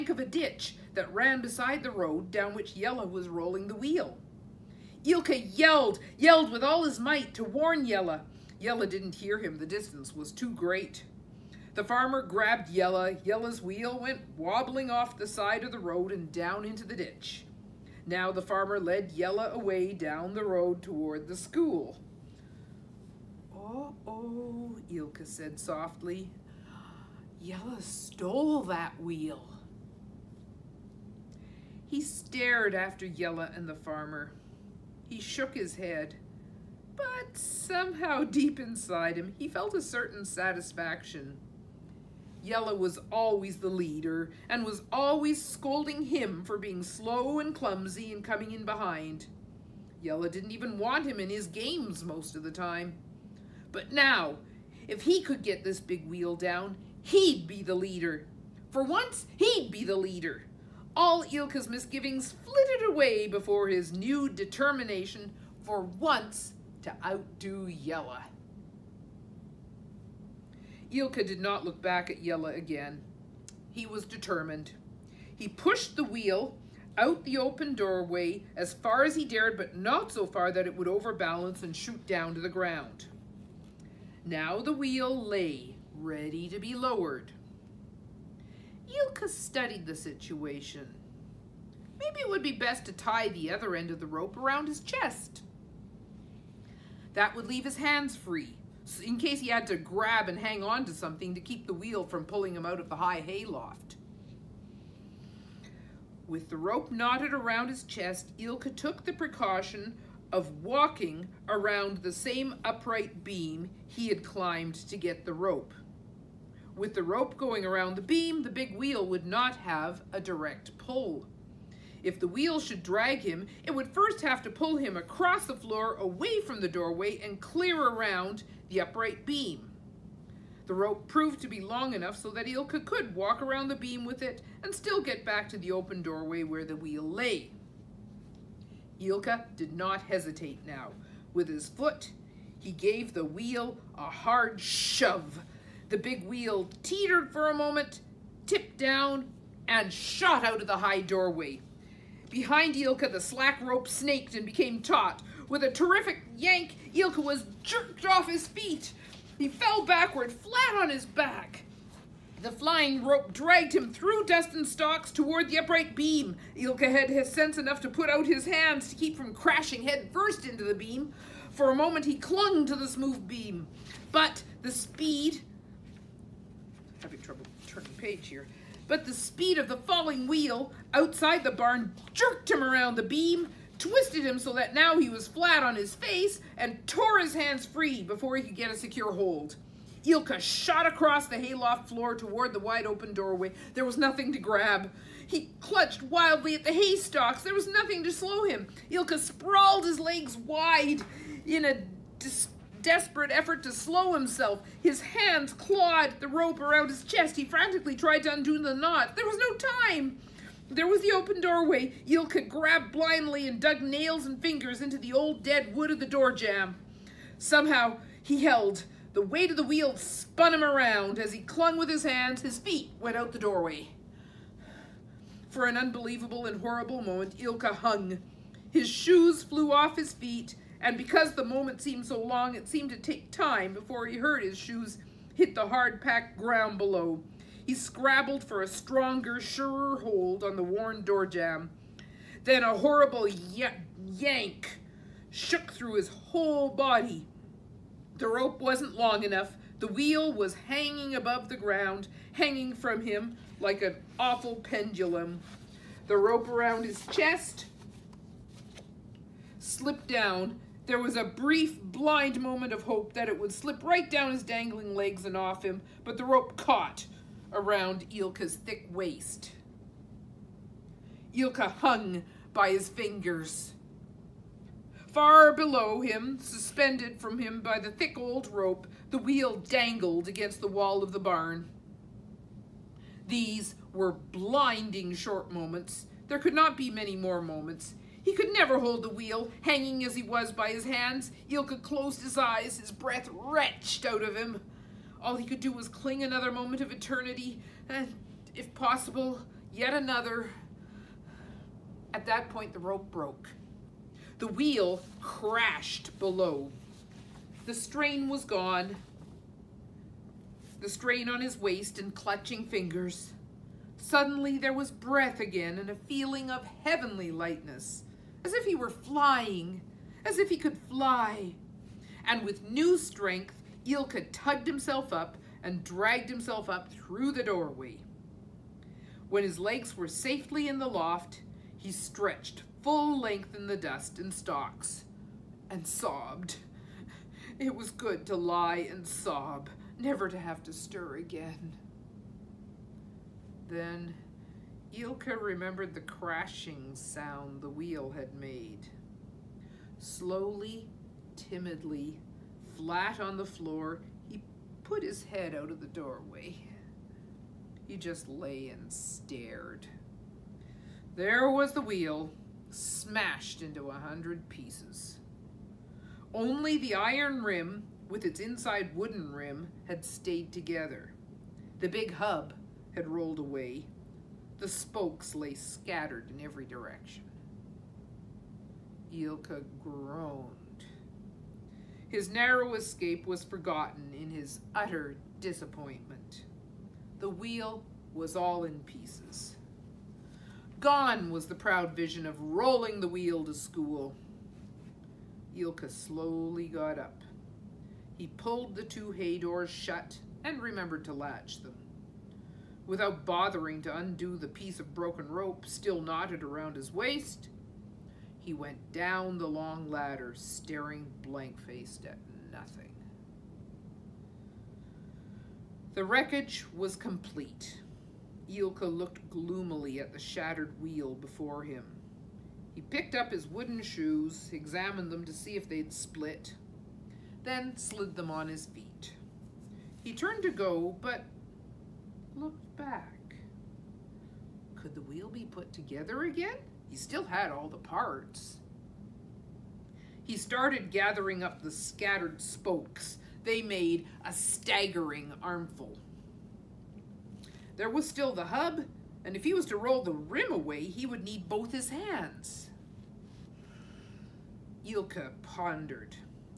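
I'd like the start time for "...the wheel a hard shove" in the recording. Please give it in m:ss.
2:23.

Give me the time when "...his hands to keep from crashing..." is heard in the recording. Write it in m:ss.
2:48.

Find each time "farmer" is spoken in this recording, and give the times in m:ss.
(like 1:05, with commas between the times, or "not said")
0:11, 0:18, 0:33.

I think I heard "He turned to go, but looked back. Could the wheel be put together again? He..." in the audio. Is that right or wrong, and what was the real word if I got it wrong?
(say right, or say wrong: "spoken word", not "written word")
right.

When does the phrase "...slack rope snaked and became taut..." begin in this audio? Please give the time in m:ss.
2:33.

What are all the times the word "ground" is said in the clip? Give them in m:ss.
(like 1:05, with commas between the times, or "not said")
1:22, 3:56, 4:11.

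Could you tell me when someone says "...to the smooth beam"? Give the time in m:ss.
2:52.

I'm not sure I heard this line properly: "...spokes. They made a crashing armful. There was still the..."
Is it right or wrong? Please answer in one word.
wrong.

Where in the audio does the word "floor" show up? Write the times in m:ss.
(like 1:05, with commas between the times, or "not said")
2:05, 3:11, 5:53.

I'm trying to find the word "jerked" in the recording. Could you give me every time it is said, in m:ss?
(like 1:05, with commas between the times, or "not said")
2:37, 3:02.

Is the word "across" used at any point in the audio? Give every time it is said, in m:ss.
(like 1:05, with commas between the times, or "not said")
2:04, 3:10.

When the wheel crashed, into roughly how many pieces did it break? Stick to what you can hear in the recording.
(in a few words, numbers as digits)
100.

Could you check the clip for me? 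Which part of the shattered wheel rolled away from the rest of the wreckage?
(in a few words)
The big hub.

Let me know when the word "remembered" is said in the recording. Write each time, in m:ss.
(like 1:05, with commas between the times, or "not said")
5:45, 6:40.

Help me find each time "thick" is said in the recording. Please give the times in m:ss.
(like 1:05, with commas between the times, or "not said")
4:28, 4:37.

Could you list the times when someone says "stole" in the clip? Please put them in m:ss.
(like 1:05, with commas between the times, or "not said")
0:27.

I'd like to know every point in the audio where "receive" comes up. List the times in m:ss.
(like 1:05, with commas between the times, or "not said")
not said.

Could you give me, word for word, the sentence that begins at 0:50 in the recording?
Jella didn't even want him in his games most of the time.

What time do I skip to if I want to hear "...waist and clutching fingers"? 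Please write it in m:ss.
5:11.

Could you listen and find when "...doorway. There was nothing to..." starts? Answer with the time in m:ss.
3:13.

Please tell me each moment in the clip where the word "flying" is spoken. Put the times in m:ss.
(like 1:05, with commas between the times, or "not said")
2:42, 5:18.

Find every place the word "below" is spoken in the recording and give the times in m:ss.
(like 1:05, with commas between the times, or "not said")
3:56, 4:35, 5:06.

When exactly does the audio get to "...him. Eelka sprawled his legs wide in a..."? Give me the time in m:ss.
3:18.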